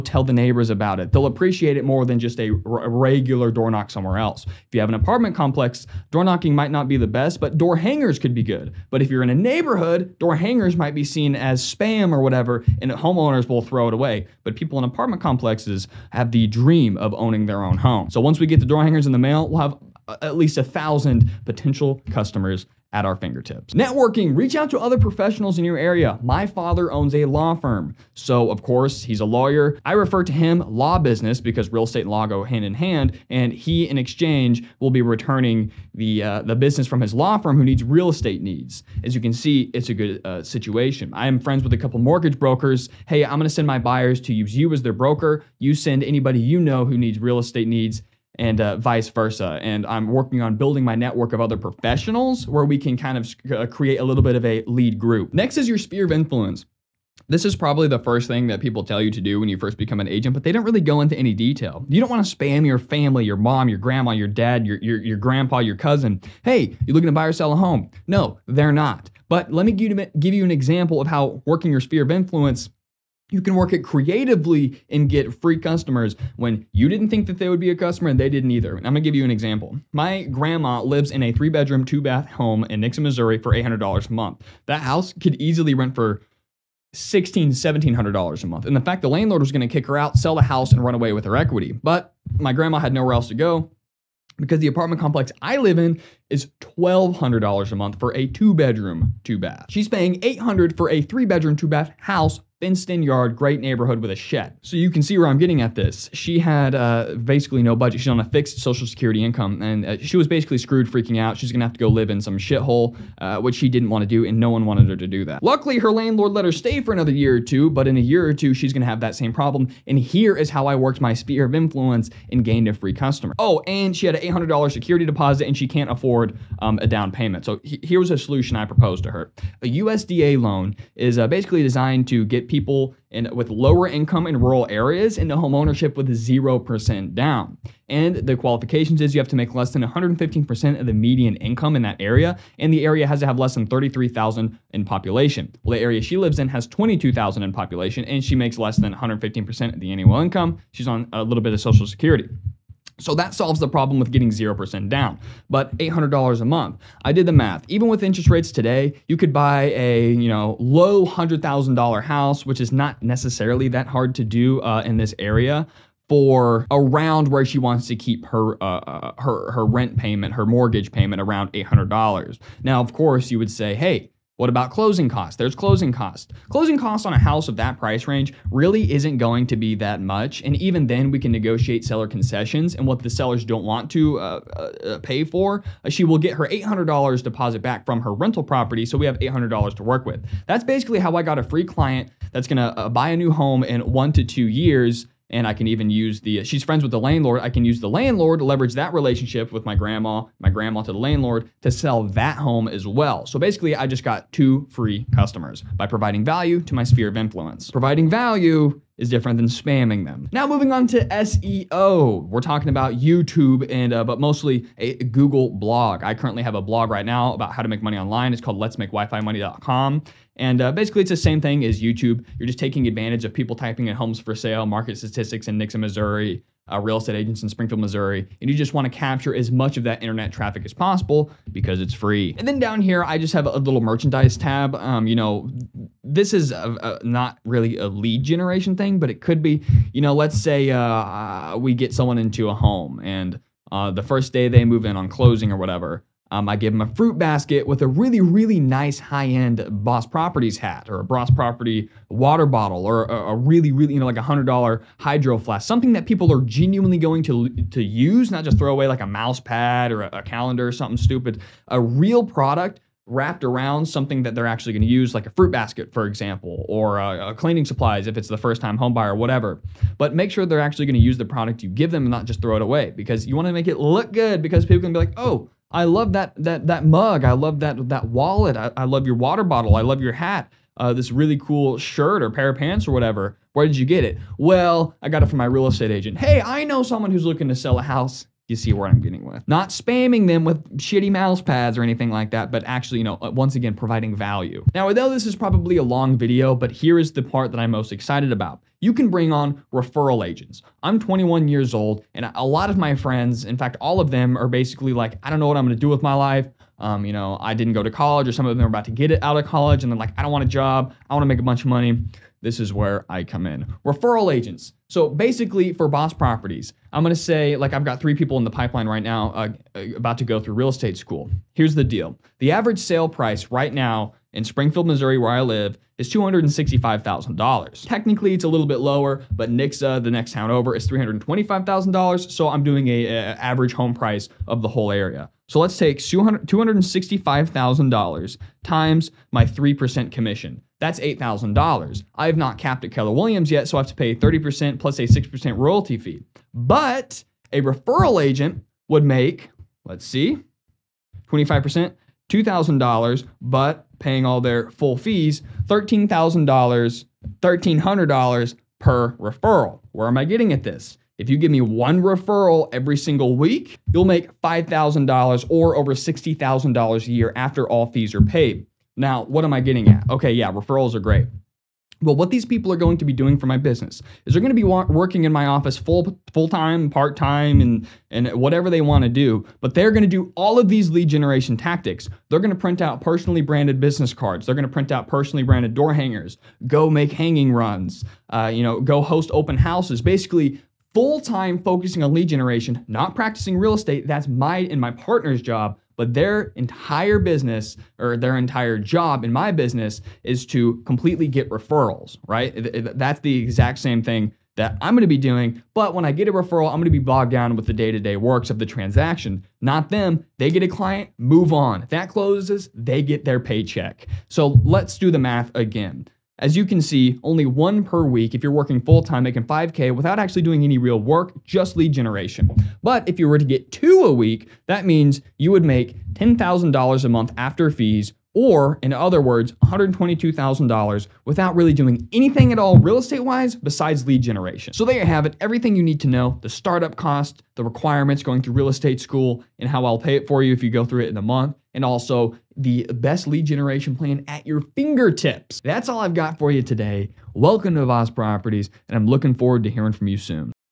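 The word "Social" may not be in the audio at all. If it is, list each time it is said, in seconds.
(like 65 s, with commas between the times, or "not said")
108 s, 151 s.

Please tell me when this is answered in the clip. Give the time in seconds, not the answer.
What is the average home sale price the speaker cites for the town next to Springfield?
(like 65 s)
330 s.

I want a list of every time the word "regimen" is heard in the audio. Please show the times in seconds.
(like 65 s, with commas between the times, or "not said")
not said.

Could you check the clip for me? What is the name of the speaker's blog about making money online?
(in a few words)
Let's Make WiFi Money.com.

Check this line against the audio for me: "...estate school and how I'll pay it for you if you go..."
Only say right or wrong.
right.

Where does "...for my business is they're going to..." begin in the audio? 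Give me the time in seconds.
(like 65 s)
373 s.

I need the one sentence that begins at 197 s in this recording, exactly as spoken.
I can use the landlord leverage that relationship with my grandma, my grandma to the landlord to sell that home as well.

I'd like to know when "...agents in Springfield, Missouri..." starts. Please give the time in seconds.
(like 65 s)
227 s.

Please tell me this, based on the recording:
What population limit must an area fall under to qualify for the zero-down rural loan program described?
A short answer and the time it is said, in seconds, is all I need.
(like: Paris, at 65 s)
33,000, at 143 s.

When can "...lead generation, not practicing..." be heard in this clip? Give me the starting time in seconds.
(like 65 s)
392 s.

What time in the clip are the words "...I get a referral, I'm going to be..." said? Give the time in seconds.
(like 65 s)
406 s.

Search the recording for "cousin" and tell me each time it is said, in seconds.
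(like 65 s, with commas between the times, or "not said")
65 s.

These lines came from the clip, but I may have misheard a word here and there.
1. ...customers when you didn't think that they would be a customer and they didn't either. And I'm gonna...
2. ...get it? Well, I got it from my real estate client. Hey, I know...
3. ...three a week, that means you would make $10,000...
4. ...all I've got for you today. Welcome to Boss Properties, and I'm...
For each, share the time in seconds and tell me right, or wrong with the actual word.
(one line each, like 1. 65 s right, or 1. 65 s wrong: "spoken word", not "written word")
1. 75 s right
2. 283 s wrong: "agent", not "client"
3. 423 s wrong: "two", not "three"
4. 445 s right.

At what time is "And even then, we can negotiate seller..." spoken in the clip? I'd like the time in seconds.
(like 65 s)
180 s.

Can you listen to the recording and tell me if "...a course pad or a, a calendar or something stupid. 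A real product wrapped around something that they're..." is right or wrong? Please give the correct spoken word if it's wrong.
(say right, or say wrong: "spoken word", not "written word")
wrong: "mouse", not "course".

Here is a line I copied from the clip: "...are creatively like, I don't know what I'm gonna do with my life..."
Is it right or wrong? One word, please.
wrong.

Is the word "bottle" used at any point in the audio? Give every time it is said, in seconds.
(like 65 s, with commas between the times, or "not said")
252 s, 279 s.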